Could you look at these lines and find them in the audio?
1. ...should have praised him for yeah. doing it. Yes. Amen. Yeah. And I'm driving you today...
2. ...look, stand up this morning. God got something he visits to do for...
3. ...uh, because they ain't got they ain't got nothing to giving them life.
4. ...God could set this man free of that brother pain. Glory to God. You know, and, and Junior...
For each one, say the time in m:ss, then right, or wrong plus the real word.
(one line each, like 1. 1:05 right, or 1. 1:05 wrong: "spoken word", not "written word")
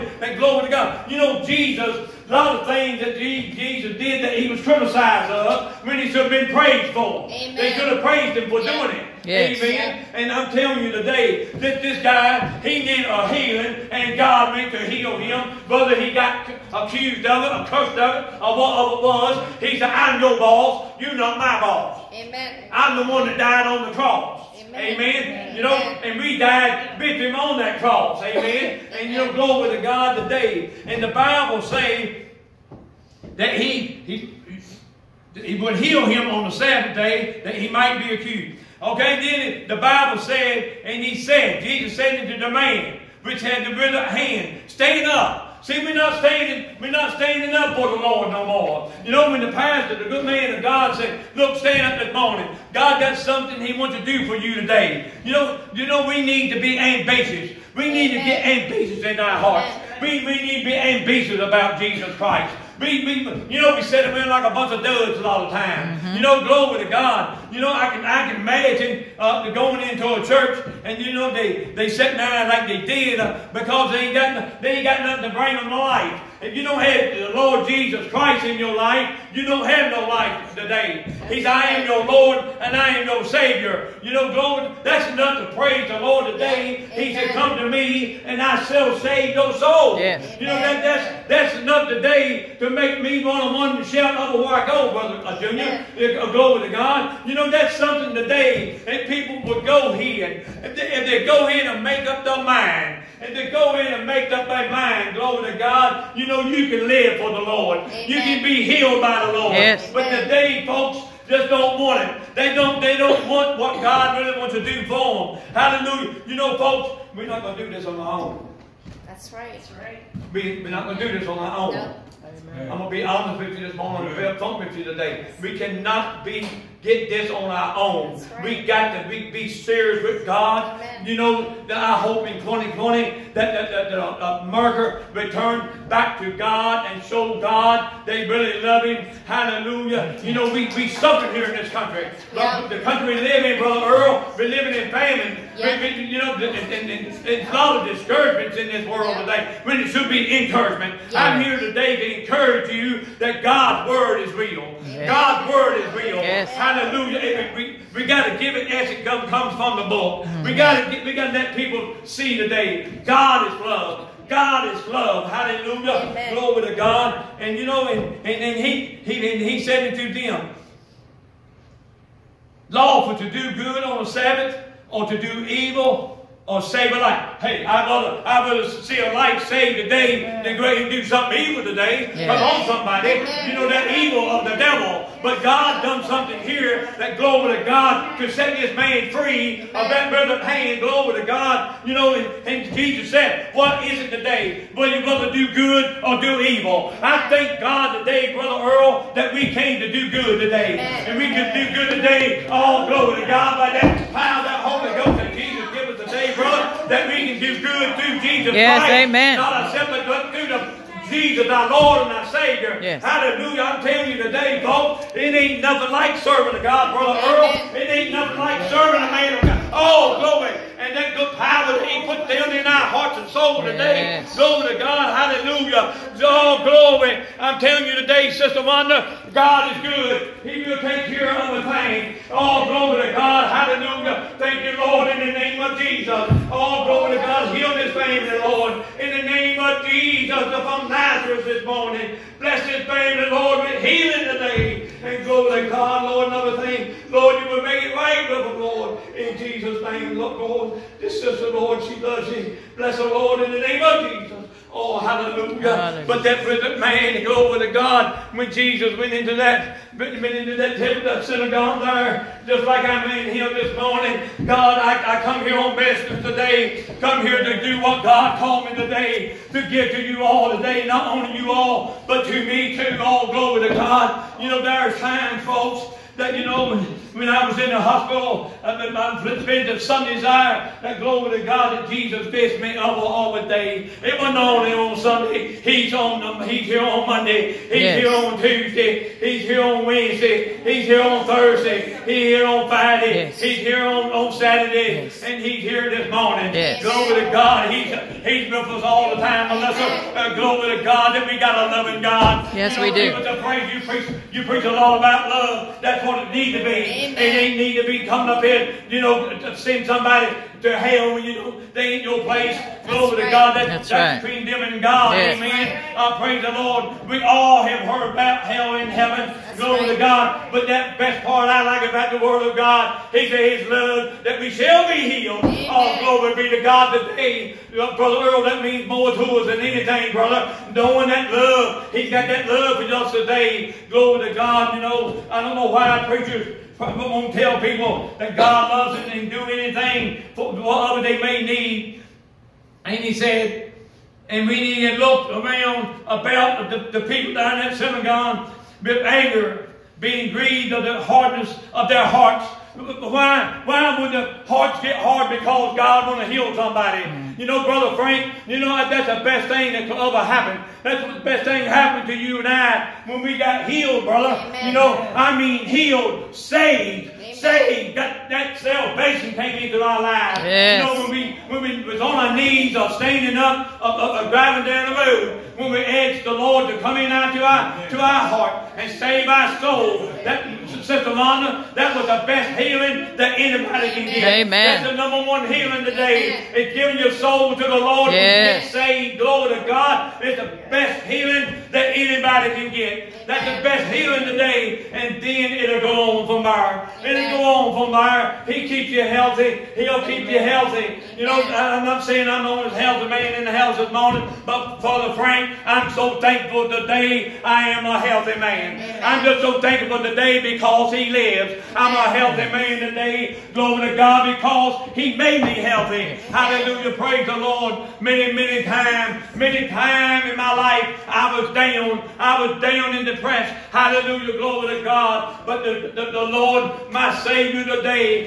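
1. 0:07 wrong: "telling", not "driving"
2. 0:51 wrong: "wants", not "visits"
3. 1:13 wrong: "bring", not "giving"
4. 3:07 wrong: "Jesus", not "Junior".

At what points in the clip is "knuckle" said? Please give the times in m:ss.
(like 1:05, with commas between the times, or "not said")
not said.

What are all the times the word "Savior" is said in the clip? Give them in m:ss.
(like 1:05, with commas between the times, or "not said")
1:23, 3:32.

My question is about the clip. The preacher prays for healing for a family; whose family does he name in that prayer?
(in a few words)
Lazarus.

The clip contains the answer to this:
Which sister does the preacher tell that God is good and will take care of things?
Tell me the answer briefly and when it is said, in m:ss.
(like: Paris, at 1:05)
Sister Wanda, at 3:48.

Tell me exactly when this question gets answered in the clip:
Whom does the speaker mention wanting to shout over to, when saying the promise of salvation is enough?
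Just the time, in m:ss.
1:34.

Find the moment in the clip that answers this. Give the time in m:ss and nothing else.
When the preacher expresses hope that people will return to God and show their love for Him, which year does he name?
2:12.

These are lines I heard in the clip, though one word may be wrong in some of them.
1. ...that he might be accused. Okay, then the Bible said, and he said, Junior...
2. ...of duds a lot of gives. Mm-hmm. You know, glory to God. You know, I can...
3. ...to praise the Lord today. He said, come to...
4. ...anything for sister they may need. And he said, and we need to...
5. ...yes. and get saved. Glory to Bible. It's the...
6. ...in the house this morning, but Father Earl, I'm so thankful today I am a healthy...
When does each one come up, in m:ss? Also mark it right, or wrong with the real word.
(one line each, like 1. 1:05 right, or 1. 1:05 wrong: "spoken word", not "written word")
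1. 0:37 wrong: "Jesus", not "Junior"
2. 1:04 wrong: "times", not "gives"
3. 1:25 right
4. 5:39 wrong: "whatever", not "sister"
5. 6:28 wrong: "God", not "Bible"
6. 6:43 wrong: "Frank", not "Earl".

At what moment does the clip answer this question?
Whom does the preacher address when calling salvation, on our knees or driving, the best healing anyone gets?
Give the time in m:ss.
6:20.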